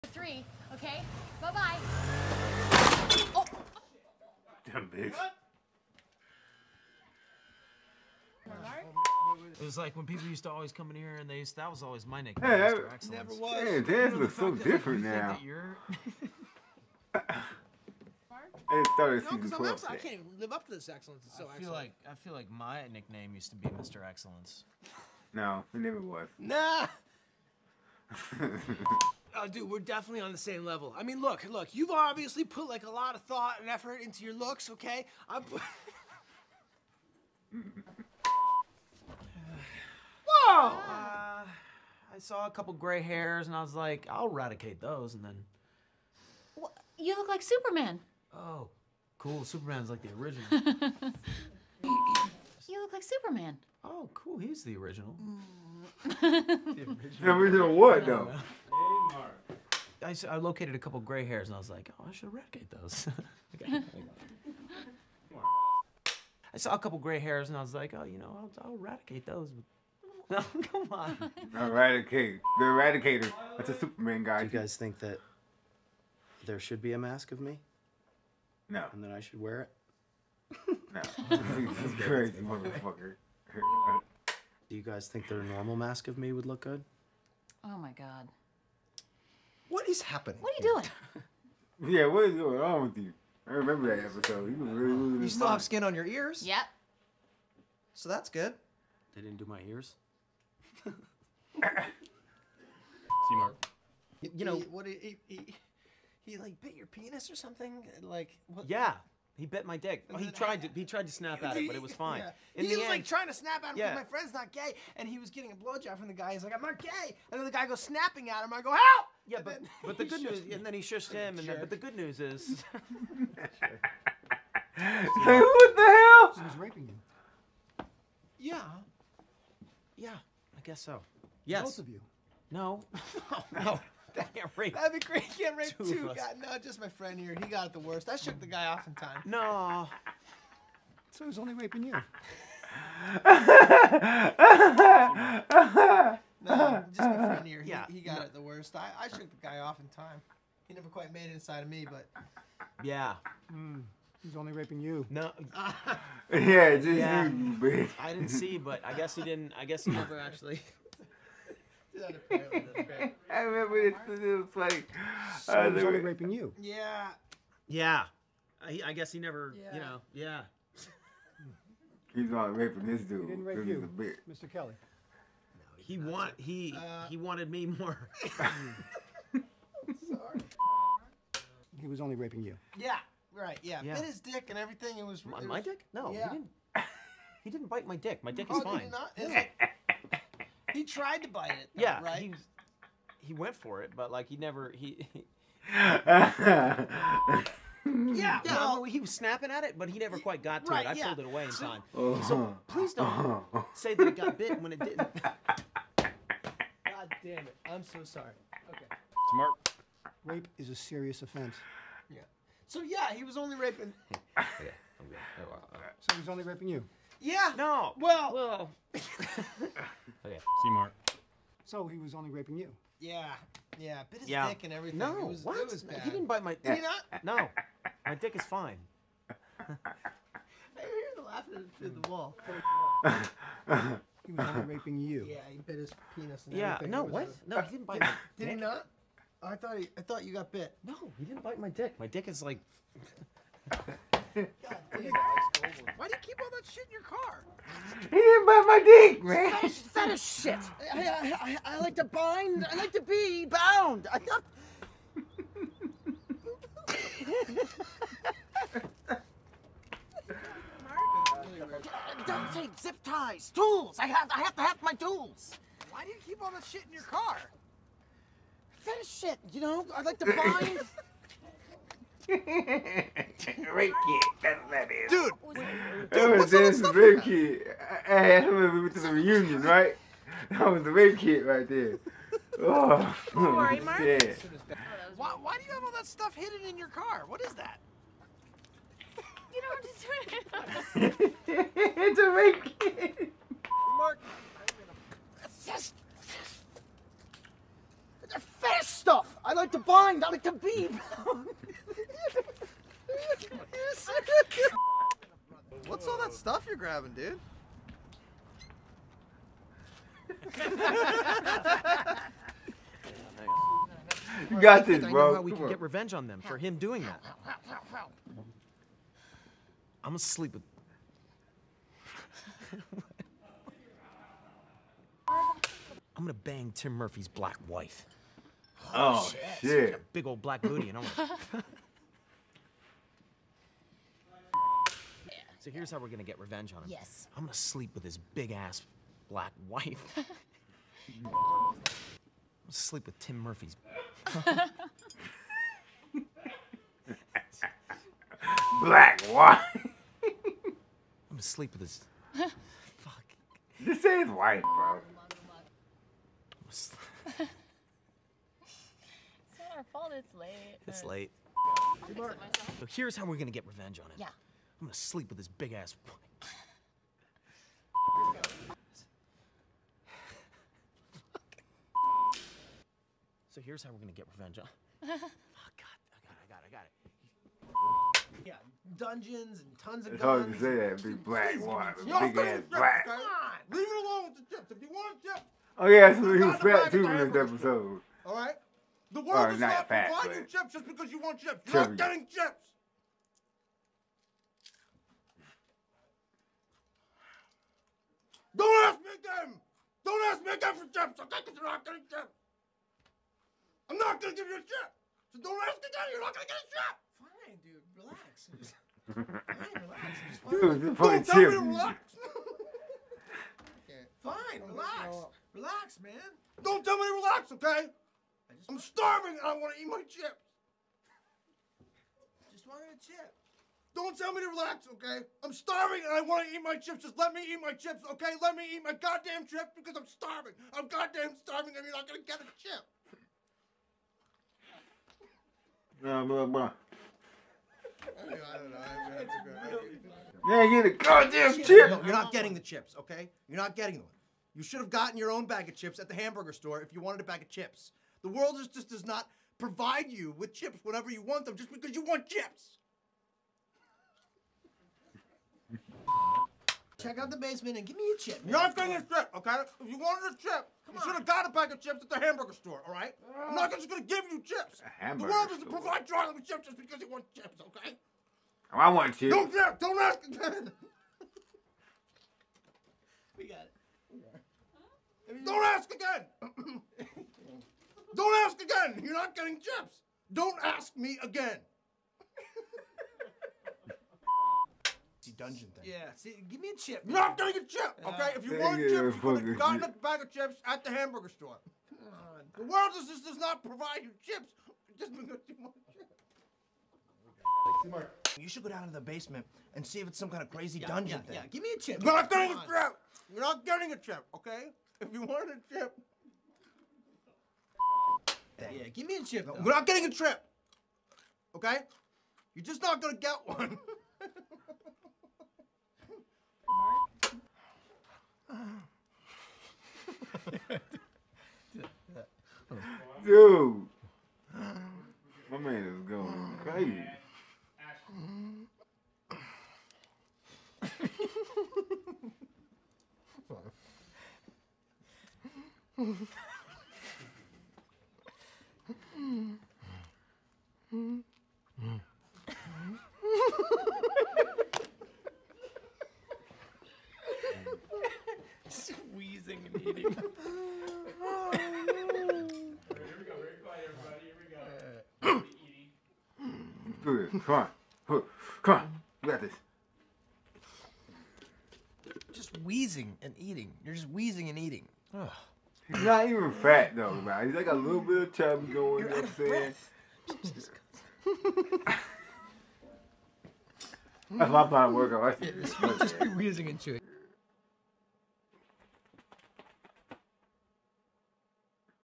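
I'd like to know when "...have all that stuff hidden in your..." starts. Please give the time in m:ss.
4:45.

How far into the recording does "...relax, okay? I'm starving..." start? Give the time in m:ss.
7:04.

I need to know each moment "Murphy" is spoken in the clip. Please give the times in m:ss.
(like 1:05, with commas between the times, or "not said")
5:26, 5:43.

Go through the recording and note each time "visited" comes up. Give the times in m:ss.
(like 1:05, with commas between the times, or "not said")
not said.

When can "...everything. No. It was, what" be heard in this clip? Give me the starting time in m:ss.
3:44.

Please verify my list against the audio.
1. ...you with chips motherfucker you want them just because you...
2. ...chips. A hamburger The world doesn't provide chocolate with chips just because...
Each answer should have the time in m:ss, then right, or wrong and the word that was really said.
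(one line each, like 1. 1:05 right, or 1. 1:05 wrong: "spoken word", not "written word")
1. 7:30 wrong: "whenever", not "motherfucker"
2. 7:44 right.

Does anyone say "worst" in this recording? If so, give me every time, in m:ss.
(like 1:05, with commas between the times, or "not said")
2:17, 2:28.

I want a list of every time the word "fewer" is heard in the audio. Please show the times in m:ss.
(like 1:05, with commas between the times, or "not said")
not said.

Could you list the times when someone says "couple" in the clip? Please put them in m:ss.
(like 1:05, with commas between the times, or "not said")
0:42, 1:00, 1:06.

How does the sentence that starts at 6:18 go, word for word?
Yeah, dungeons and tons of guns.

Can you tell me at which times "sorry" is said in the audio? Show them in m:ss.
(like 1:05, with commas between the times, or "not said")
2:58, 3:28.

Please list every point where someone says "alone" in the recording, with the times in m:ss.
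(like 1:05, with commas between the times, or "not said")
6:24.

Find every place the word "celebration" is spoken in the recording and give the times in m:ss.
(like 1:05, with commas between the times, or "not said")
not said.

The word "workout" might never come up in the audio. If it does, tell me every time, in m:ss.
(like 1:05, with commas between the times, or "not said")
9:34.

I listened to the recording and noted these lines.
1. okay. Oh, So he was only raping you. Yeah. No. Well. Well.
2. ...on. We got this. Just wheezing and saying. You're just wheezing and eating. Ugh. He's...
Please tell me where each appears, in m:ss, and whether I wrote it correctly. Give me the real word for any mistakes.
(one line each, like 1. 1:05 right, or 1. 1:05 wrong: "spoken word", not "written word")
1. 3:34 right
2. 9:18 wrong: "eating", not "saying".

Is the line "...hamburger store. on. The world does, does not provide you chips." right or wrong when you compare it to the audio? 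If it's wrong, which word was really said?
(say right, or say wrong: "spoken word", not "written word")
right.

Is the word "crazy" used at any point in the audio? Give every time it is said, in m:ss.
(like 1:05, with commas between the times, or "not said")
1:22, 8:20, 8:46.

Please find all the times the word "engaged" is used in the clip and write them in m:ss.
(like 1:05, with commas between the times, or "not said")
not said.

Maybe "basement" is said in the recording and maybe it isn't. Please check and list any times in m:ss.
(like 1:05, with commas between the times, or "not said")
7:37, 8:19.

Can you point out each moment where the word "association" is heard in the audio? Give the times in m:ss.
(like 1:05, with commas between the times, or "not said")
not said.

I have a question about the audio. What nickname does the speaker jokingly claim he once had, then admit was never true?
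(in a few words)
Mr. Excellence.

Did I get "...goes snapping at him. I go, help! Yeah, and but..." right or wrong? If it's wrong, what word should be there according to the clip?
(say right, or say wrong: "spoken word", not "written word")
right.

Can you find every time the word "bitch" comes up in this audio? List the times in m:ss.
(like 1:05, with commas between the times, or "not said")
0:04.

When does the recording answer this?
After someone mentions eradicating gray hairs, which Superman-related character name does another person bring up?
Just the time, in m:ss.
1:12.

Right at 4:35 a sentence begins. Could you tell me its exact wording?
Dude, dude what's all this Ricky.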